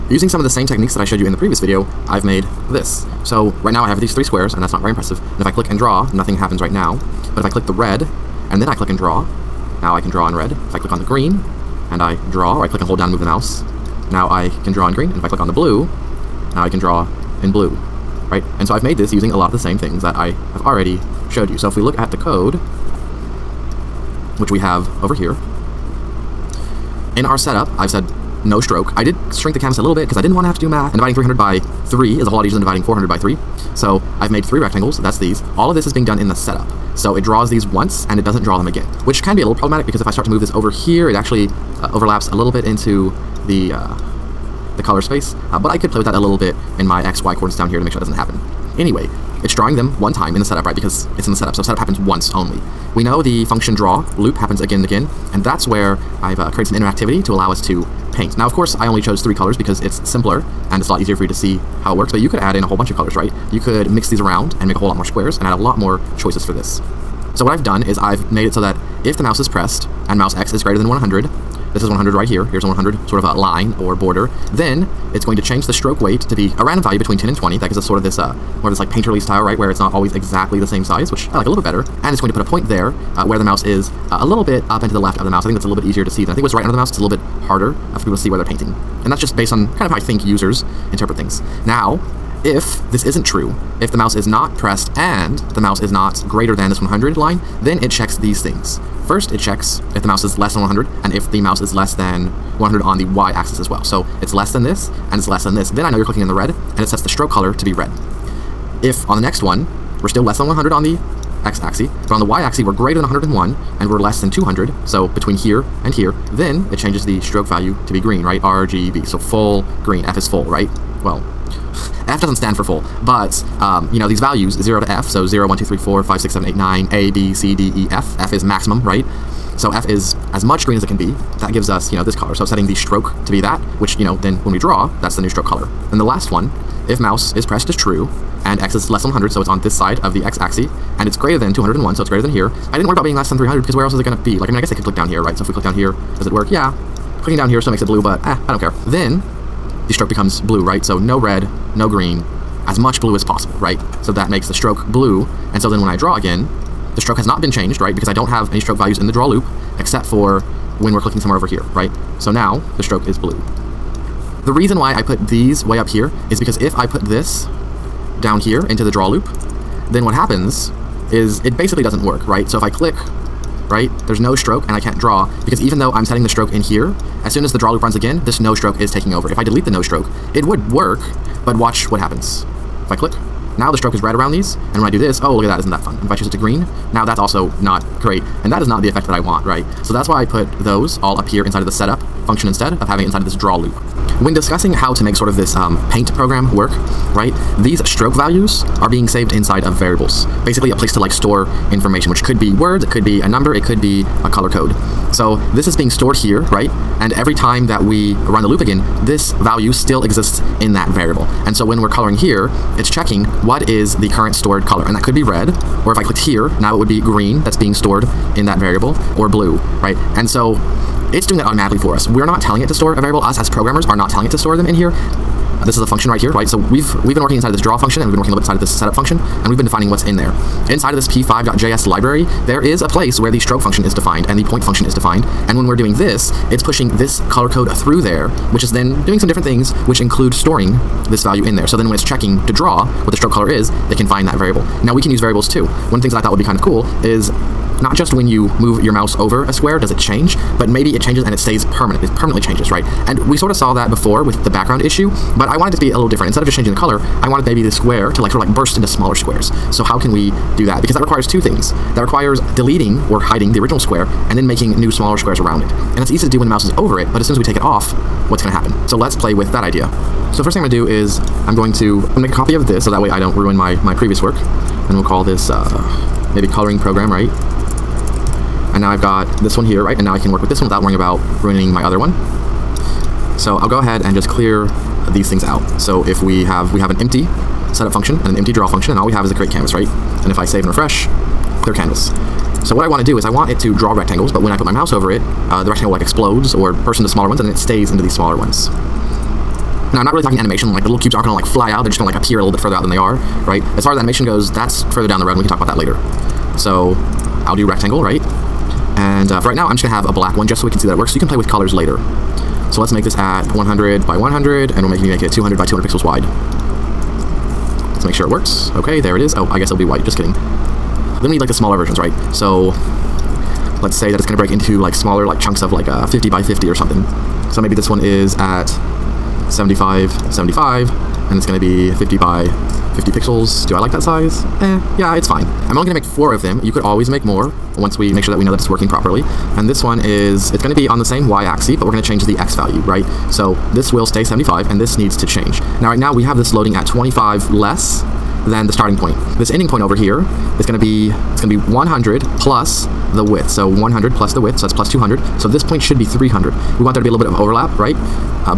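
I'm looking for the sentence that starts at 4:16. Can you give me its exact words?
Instead of just changing the color, I wanted maybe the square to like sort of like burst into smaller squares.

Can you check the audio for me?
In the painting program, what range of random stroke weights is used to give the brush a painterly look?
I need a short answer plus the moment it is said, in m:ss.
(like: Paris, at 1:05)
Between 10 and 20, at 1:16.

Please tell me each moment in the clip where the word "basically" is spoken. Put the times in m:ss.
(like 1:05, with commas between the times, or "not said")
2:51, 3:20.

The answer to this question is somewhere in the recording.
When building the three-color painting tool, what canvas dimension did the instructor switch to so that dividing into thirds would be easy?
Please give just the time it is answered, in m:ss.
0:30.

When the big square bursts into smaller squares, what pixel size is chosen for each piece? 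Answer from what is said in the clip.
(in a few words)
50 by 50.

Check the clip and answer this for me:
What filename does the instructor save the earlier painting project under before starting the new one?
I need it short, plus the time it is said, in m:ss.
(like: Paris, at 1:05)
coloring program, at 4:36.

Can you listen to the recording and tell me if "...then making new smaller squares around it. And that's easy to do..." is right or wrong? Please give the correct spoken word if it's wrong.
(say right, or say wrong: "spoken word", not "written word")
right.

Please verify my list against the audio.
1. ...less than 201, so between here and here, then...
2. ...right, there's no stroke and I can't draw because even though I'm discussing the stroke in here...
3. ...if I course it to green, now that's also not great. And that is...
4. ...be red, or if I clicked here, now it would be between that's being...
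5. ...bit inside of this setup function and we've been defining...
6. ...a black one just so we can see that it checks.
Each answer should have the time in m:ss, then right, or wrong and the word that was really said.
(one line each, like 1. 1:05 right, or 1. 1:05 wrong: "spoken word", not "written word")
1. 1:53 wrong: "200", not "201"
2. 2:53 wrong: "setting", not "discussing"
3. 3:06 wrong: "choose", not "course"
4. 3:35 wrong: "green", not "between"
5. 3:48 right
6. 5:10 wrong: "works", not "checks".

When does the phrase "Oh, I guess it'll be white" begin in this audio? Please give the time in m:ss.
5:19.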